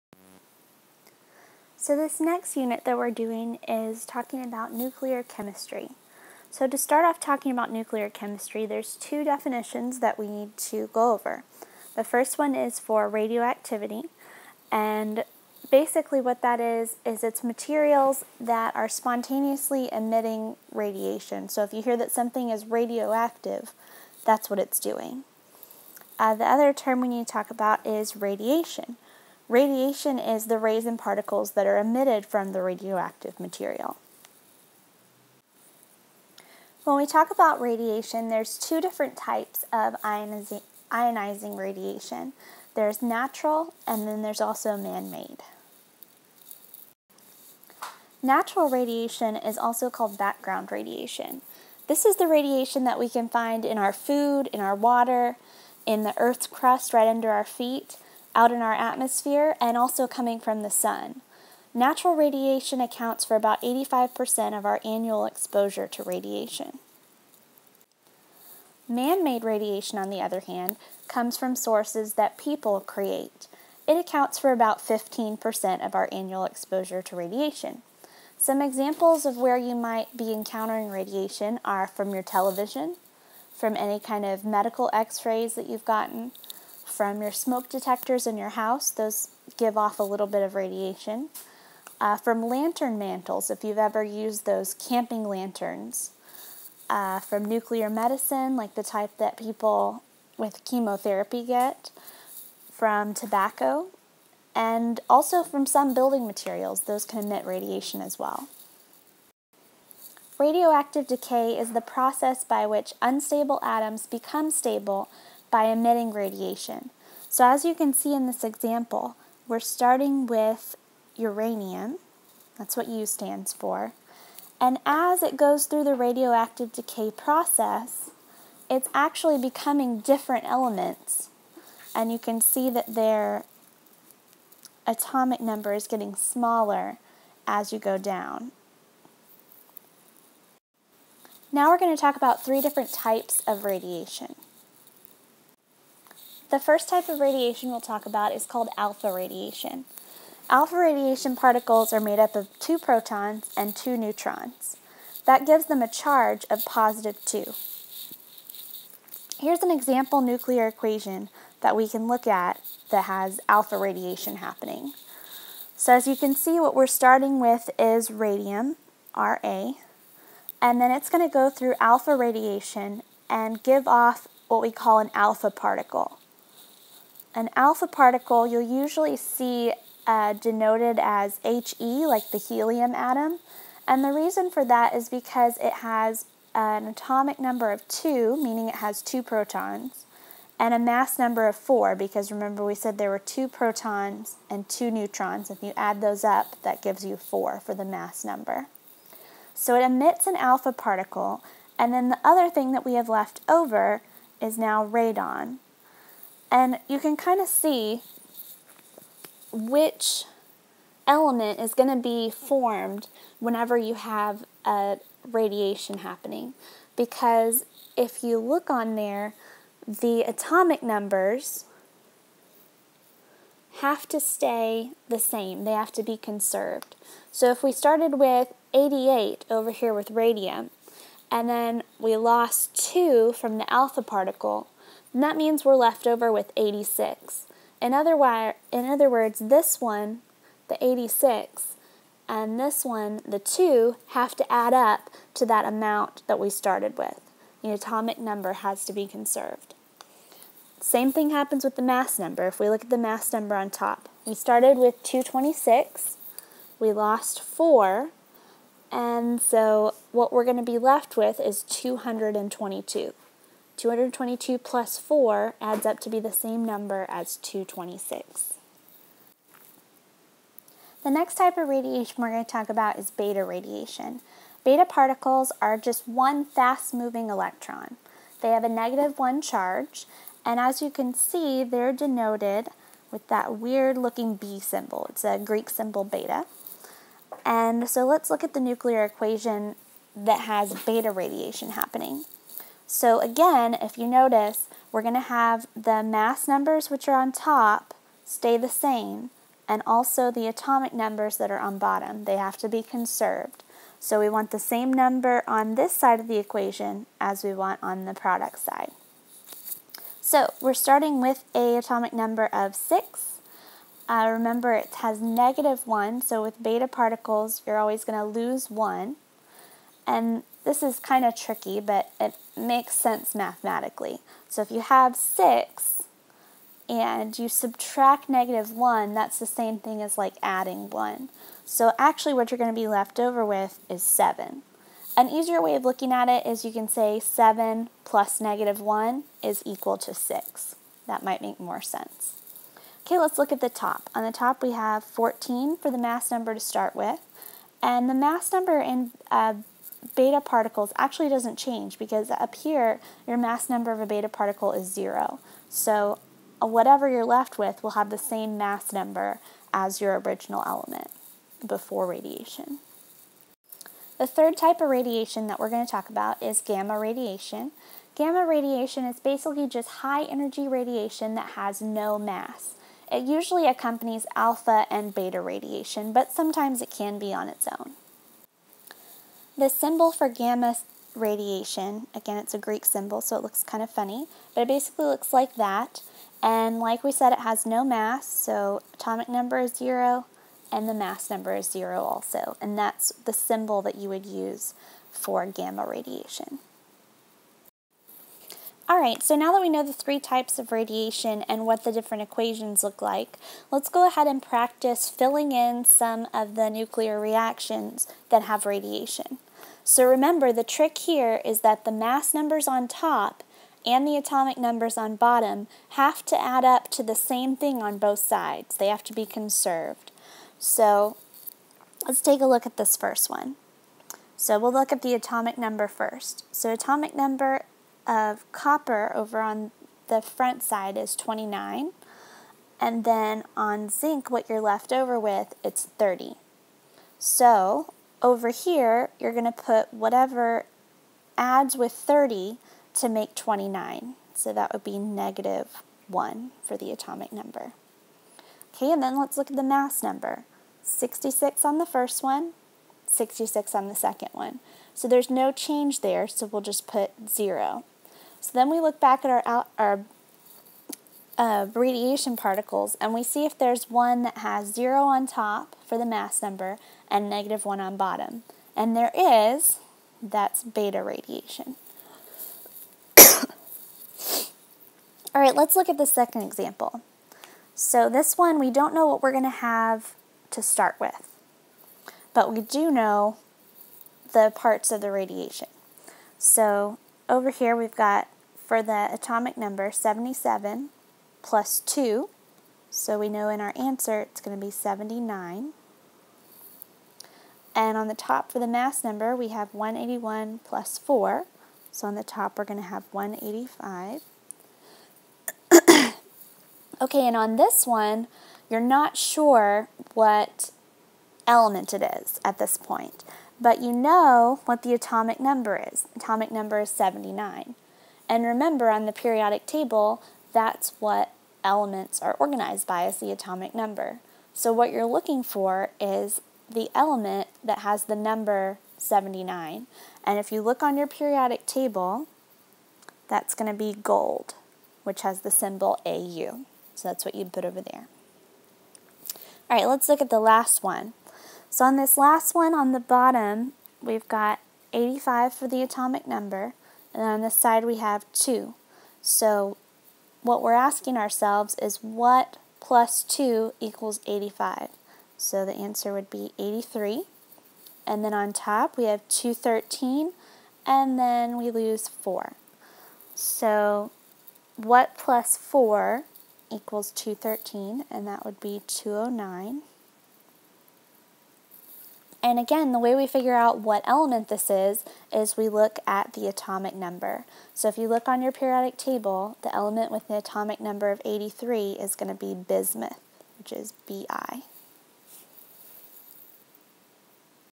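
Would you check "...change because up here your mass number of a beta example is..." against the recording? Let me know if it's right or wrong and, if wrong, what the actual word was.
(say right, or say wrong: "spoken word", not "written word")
wrong: "particle", not "example".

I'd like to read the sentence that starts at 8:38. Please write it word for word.
And remember, on the periodic table, that's what elements are organized by is the atomic number.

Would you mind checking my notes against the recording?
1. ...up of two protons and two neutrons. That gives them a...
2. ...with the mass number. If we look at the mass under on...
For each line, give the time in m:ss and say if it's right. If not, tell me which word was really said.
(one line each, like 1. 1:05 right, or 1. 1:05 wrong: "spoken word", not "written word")
1. 2:32 right
2. 4:11 wrong: "number", not "under".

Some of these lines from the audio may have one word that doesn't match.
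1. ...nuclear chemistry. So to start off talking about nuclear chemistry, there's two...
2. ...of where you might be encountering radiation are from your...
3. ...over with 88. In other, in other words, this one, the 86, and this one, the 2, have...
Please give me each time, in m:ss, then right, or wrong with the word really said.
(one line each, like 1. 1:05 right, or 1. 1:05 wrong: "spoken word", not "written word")
1. 0:04 right
2. 1:19 right
3. 3:56 wrong: "86", not "88".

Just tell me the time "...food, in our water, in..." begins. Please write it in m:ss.
0:53.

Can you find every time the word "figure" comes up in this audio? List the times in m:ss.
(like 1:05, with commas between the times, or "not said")
9:33.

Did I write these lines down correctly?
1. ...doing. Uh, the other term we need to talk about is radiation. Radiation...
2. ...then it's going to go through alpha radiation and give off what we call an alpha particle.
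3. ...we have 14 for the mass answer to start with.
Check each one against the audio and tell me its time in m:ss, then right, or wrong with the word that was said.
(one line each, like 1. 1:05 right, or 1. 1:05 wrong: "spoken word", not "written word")
1. 0:24 right
2. 2:50 right
3. 5:44 wrong: "number", not "answer".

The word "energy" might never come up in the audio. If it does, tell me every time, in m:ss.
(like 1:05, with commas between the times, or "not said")
6:10.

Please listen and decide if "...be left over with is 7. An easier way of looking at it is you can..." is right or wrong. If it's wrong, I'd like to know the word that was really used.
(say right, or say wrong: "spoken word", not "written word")
right.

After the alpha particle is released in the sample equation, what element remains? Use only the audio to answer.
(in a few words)
radon.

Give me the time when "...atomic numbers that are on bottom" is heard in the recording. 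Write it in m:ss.
5:00.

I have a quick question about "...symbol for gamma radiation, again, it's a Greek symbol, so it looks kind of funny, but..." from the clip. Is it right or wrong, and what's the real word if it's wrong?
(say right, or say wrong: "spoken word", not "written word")
right.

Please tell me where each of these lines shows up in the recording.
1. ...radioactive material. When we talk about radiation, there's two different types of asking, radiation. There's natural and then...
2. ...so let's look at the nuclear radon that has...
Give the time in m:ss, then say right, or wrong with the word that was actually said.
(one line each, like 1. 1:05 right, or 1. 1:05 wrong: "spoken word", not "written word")
1. 0:32 wrong: "ionizing", not "asking"
2. 4:47 wrong: "equation", not "radon".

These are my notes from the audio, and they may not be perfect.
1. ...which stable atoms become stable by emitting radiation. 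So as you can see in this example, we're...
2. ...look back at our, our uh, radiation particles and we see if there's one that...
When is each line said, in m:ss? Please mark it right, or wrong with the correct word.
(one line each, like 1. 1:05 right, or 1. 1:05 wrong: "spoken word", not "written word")
1. 1:52 wrong: "unstable", not "stable"
2. 7:38 right.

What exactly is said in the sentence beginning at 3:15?
If you add those up, that gives you 4 for the mass number.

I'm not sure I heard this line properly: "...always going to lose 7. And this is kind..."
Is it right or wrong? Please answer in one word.
wrong.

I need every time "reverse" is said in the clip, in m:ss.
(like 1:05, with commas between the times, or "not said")
not said.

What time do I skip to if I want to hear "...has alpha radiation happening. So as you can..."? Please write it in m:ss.
2:43.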